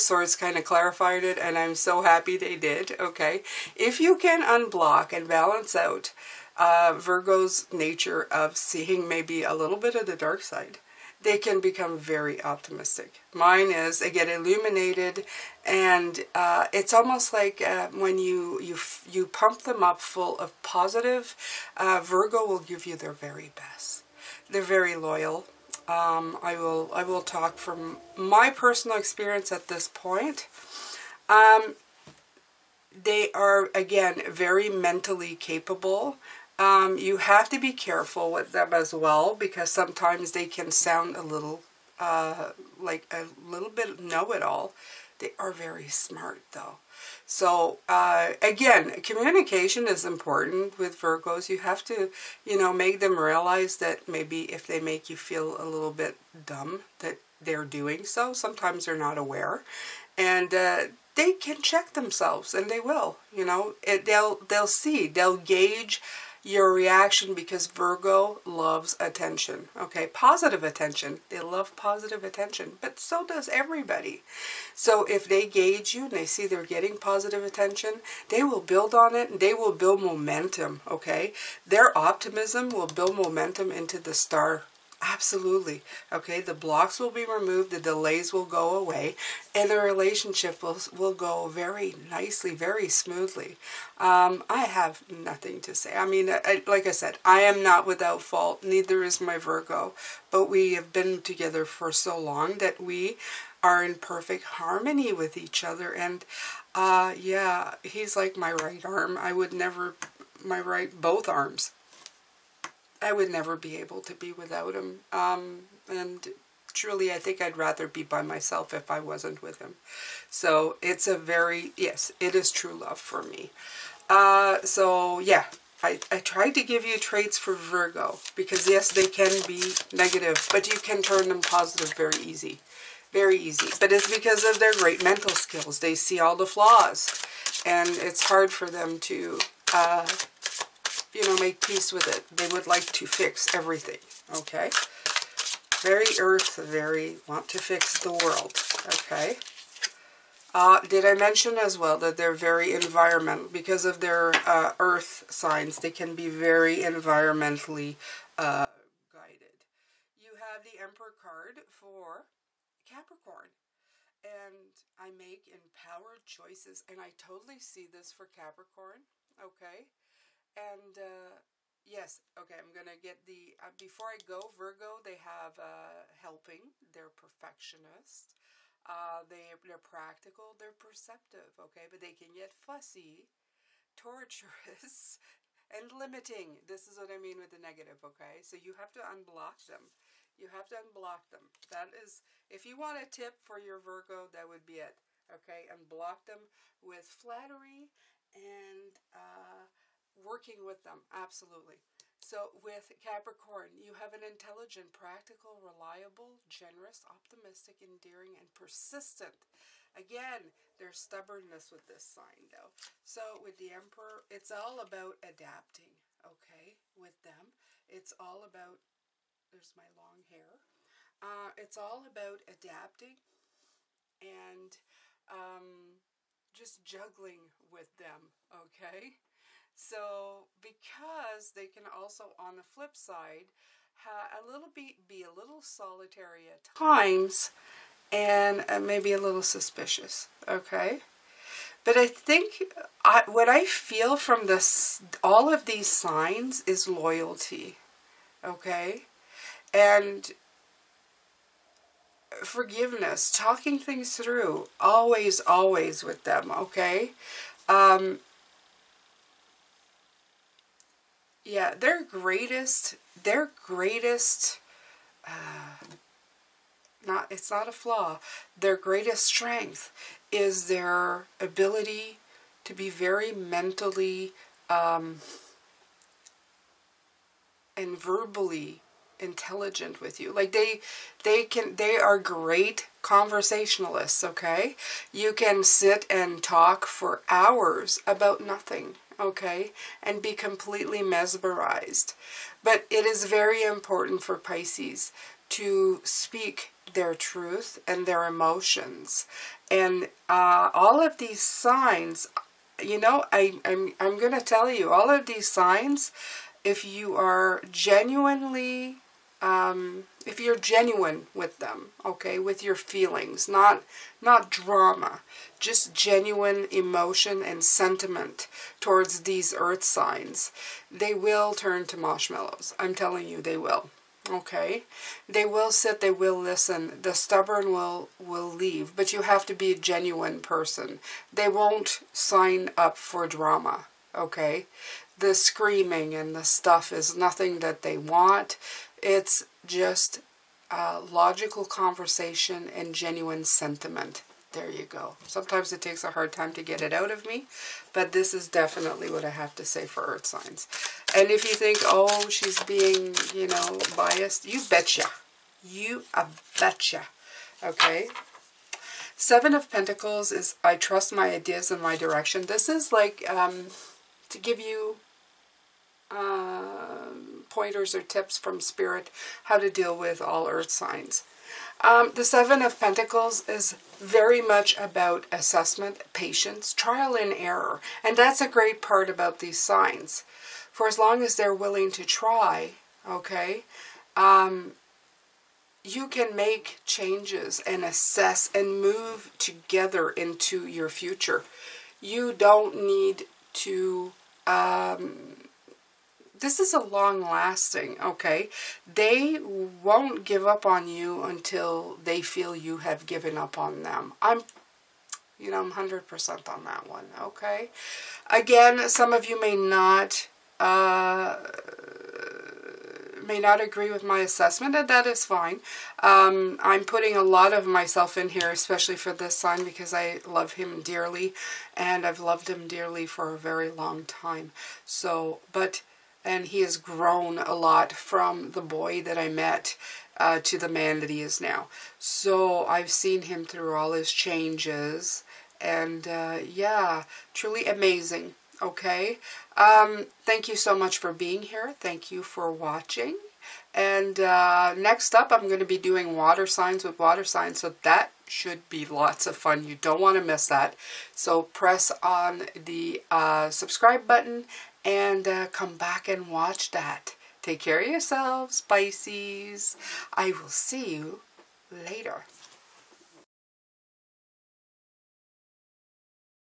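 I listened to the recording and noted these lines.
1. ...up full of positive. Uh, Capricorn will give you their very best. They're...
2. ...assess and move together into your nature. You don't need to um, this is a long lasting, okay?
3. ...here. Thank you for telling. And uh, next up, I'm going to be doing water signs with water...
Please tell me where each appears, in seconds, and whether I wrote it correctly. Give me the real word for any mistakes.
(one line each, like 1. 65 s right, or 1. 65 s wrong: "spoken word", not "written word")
1. 19 s wrong: "Virgo", not "Capricorn"
2. 387 s wrong: "future", not "nature"
3. 441 s wrong: "watching", not "telling".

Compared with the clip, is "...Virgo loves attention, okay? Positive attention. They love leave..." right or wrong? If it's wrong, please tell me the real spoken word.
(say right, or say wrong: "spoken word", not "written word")
wrong: "positive", not "leave".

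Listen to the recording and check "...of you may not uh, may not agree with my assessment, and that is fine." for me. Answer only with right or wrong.
right.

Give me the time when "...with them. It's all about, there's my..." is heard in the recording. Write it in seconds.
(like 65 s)
216 s.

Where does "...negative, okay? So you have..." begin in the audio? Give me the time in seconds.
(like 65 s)
187 s.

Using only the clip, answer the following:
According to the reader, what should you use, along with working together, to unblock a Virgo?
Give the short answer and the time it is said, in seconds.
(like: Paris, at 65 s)
Flattery, at 197 s.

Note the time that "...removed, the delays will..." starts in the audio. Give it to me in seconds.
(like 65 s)
87 s.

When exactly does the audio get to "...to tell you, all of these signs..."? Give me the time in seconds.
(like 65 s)
304 s.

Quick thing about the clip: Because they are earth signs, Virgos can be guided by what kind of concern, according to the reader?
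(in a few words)
Environmental.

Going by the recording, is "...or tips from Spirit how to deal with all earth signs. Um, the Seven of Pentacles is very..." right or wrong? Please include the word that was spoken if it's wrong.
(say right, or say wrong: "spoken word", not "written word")
right.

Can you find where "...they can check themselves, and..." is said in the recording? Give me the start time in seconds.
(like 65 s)
61 s.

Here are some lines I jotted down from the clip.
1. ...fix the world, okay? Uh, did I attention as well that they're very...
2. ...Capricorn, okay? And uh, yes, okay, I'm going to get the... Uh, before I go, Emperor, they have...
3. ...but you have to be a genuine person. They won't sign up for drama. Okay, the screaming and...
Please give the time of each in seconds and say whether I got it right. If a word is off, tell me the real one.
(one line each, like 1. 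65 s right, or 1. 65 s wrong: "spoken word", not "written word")
1. 147 s wrong: "mention", not "attention"
2. 168 s wrong: "Virgo", not "Emperor"
3. 328 s right.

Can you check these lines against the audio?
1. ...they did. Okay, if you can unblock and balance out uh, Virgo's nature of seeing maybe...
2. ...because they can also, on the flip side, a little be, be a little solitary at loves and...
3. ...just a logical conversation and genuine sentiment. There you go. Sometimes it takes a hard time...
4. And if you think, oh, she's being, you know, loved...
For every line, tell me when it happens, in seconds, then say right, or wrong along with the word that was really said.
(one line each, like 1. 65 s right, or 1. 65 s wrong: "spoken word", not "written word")
1. 2 s right
2. 230 s wrong: "times", not "loves"
3. 339 s right
4. 351 s wrong: "biased", not "loved".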